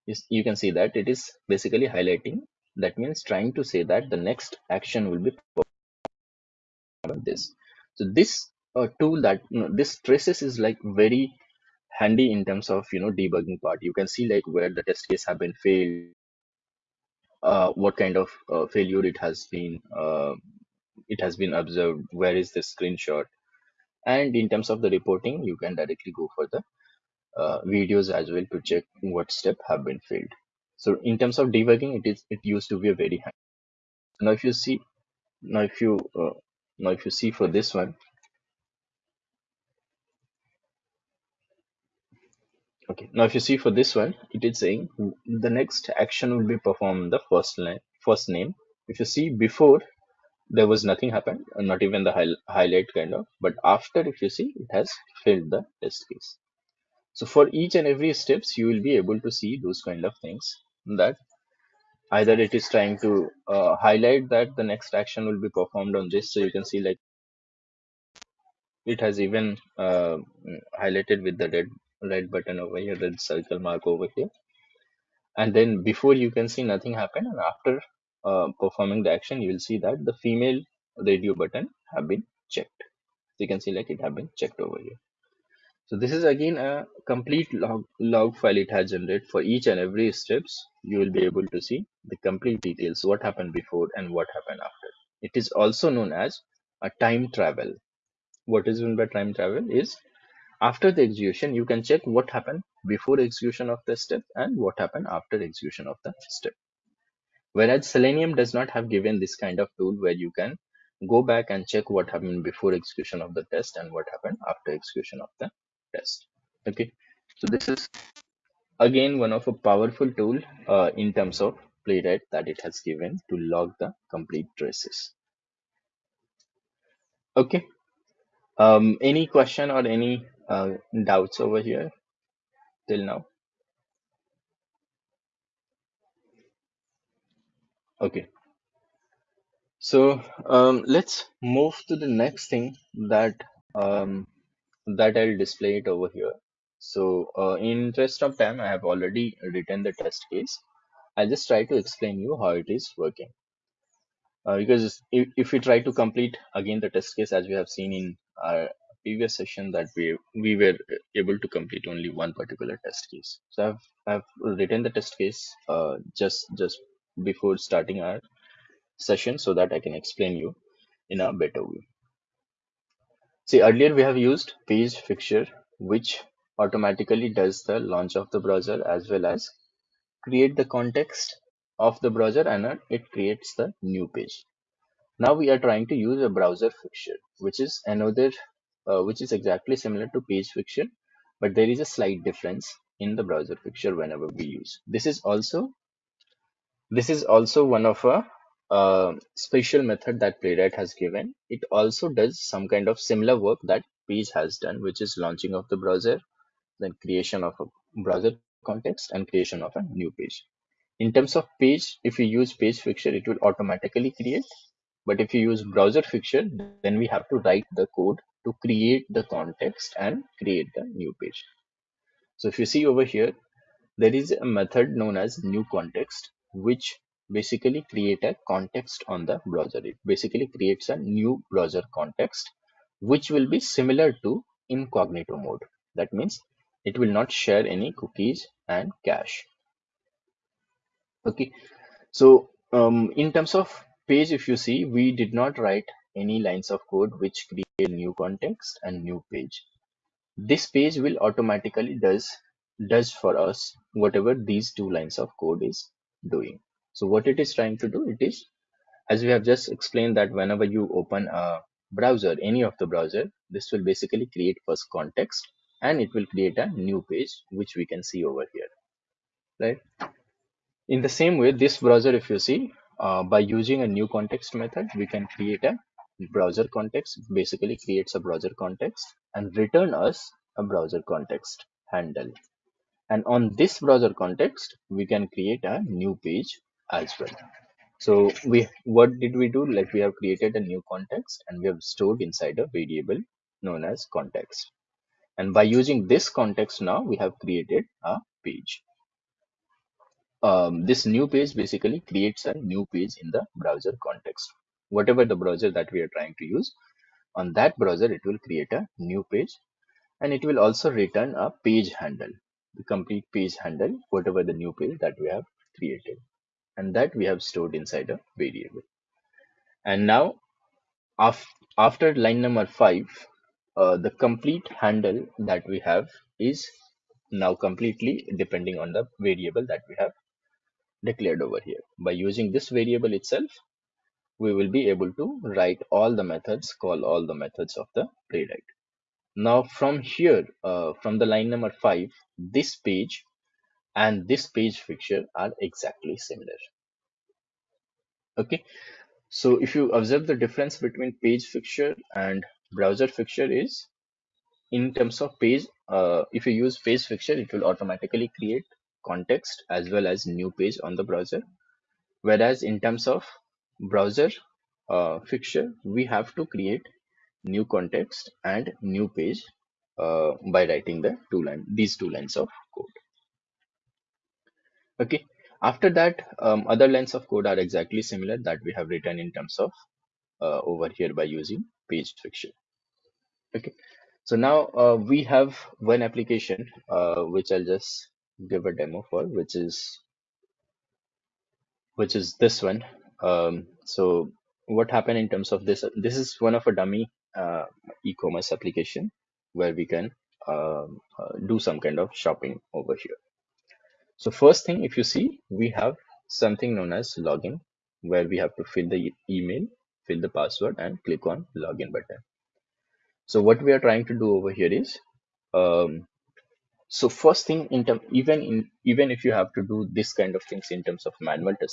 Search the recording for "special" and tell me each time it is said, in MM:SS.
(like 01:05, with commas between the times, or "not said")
03:19.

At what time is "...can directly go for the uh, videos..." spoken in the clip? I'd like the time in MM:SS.
00:25.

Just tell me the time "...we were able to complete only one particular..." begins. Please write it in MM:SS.
02:40.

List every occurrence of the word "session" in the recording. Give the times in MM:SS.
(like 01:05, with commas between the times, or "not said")
02:39, 02:48.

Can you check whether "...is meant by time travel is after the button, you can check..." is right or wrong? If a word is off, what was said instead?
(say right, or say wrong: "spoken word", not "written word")
wrong: "execution", not "button".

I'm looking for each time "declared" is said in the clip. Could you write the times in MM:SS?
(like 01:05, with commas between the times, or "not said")
05:31.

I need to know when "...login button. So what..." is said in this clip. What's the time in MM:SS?
06:51.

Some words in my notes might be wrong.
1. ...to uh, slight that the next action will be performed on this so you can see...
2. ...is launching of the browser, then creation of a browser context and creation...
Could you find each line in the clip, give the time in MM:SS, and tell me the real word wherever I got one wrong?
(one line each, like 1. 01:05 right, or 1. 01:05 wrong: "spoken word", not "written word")
1. 01:02 wrong: "highlight", not "slight"
2. 03:25 right.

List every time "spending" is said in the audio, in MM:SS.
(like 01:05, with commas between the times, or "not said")
not said.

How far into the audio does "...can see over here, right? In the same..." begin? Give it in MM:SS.
04:27.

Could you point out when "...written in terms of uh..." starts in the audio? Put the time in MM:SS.
06:18.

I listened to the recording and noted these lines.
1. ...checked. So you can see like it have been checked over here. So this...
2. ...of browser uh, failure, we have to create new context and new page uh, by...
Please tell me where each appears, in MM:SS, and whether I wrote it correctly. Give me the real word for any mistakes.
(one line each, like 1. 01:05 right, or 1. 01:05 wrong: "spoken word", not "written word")
1. 01:22 right
2. 06:03 wrong: "fixture", not "failure".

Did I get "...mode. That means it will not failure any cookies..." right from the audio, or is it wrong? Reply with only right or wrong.
wrong.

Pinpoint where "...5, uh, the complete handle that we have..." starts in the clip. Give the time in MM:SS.
05:22.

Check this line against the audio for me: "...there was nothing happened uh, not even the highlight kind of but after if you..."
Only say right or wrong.
right.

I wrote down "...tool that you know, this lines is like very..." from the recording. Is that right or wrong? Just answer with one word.
wrong.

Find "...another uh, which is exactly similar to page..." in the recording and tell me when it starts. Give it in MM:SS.
03:07.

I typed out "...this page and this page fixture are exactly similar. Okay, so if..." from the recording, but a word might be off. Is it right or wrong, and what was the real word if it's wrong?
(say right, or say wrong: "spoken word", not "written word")
right.